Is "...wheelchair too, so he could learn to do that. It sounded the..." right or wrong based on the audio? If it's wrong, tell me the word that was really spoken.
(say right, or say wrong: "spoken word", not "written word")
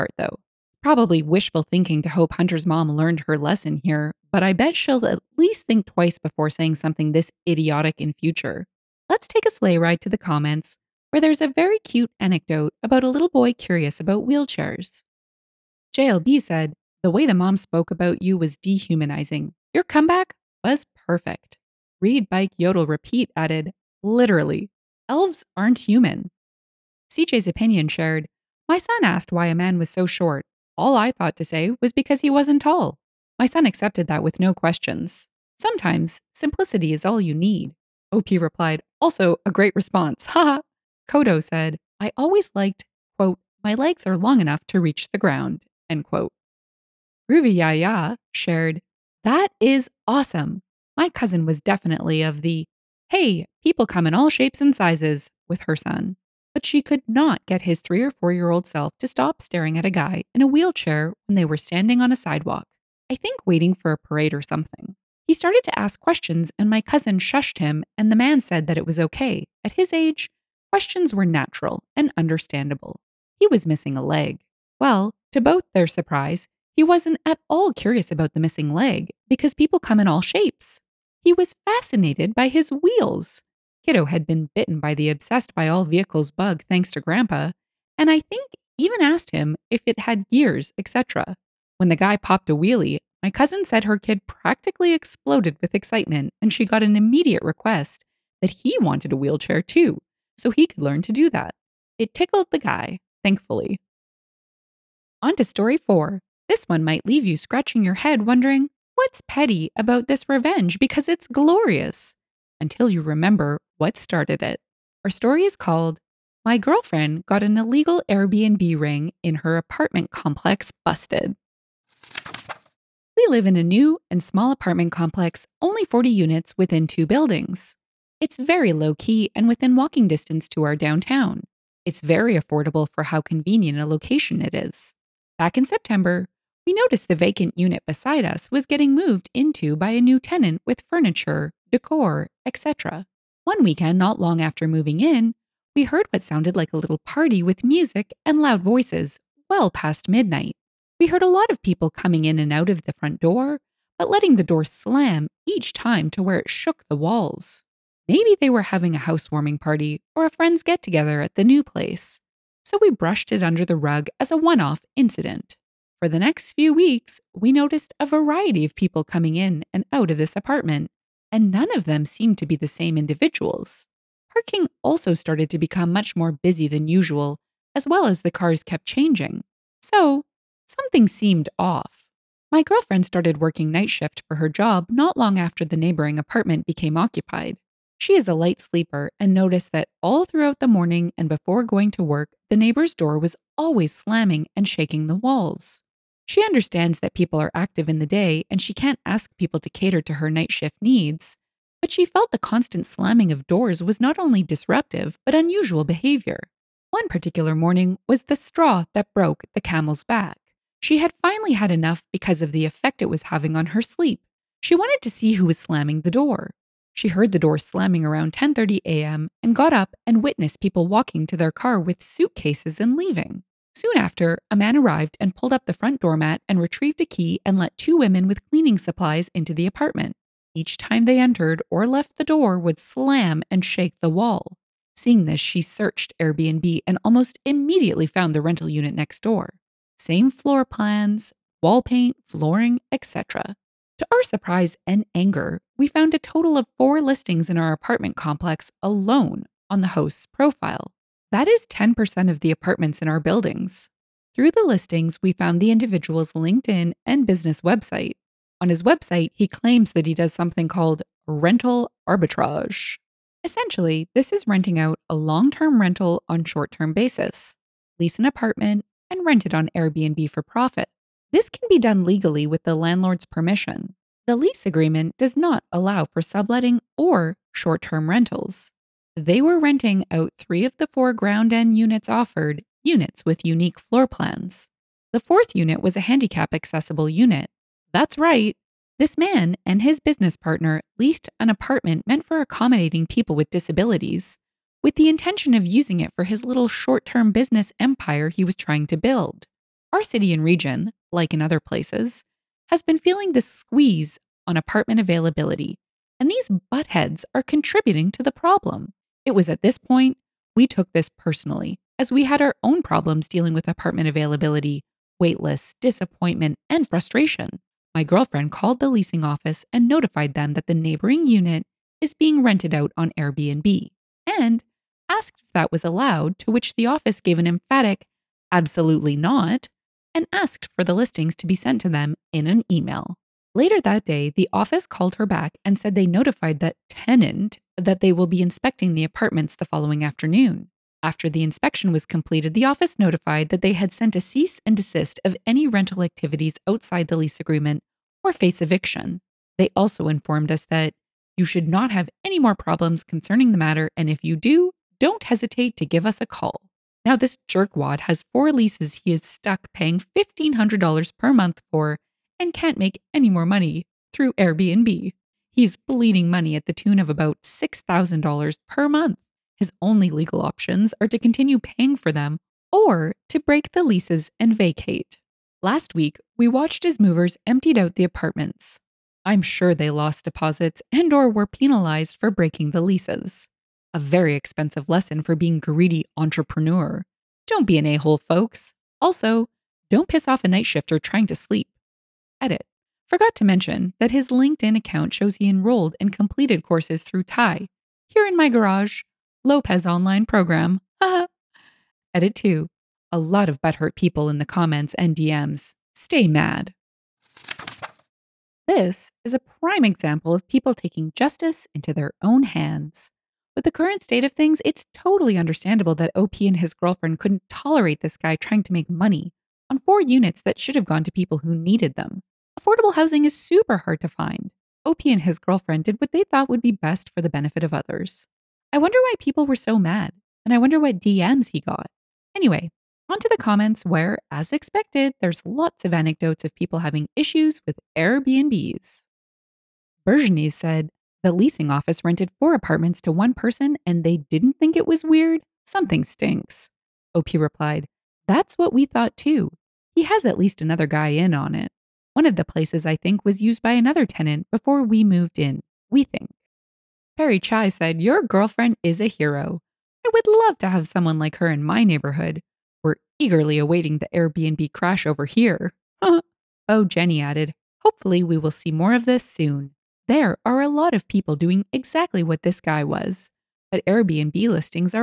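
wrong: "tickled", not "sounded".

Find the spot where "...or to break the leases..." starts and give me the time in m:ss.
6:12.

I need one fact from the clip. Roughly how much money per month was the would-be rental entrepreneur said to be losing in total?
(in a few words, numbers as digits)
$6,000.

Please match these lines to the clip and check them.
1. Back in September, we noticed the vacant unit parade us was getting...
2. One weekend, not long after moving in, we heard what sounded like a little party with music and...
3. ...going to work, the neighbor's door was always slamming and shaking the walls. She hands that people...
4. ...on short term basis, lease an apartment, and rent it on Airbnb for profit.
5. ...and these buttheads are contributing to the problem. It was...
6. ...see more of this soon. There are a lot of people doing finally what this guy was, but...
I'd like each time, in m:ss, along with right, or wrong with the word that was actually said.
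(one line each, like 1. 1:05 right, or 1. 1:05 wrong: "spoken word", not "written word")
1. 2:15 wrong: "beside", not "parade"
2. 2:23 right
3. 3:11 wrong: "understands", not "hands"
4. 4:26 right
5. 5:06 right
6. 7:48 wrong: "exactly", not "finally".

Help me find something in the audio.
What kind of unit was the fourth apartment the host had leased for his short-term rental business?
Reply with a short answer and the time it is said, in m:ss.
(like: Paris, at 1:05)
handicap accessible, at 4:46.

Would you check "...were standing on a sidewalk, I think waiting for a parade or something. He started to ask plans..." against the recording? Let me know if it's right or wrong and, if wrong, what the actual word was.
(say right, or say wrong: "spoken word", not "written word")
wrong: "questions", not "plans".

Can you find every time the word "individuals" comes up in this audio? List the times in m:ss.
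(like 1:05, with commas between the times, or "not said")
2:52, 4:15.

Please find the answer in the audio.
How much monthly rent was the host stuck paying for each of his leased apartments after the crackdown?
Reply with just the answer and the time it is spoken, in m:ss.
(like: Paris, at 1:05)
$1,500, at 5:59.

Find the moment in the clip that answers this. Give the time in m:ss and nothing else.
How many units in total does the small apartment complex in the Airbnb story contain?
2:05.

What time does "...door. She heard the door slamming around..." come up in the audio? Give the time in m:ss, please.
3:36.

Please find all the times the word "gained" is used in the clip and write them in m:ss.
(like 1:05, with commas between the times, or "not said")
not said.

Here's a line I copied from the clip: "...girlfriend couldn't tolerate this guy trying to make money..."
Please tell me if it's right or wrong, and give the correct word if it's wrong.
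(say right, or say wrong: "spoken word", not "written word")
right.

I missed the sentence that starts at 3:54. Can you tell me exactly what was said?
Seeing this, she searched Airbnb and almost immediately found the rental unit next door.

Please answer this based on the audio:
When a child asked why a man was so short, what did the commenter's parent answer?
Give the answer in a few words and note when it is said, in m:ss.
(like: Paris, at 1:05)
because he wasn't tall, at 0:31.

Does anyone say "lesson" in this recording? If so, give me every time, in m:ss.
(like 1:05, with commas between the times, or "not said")
0:03, 6:24.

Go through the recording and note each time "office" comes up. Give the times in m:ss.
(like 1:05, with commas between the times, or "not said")
5:19, 5:26, 5:34, 5:42, 7:21.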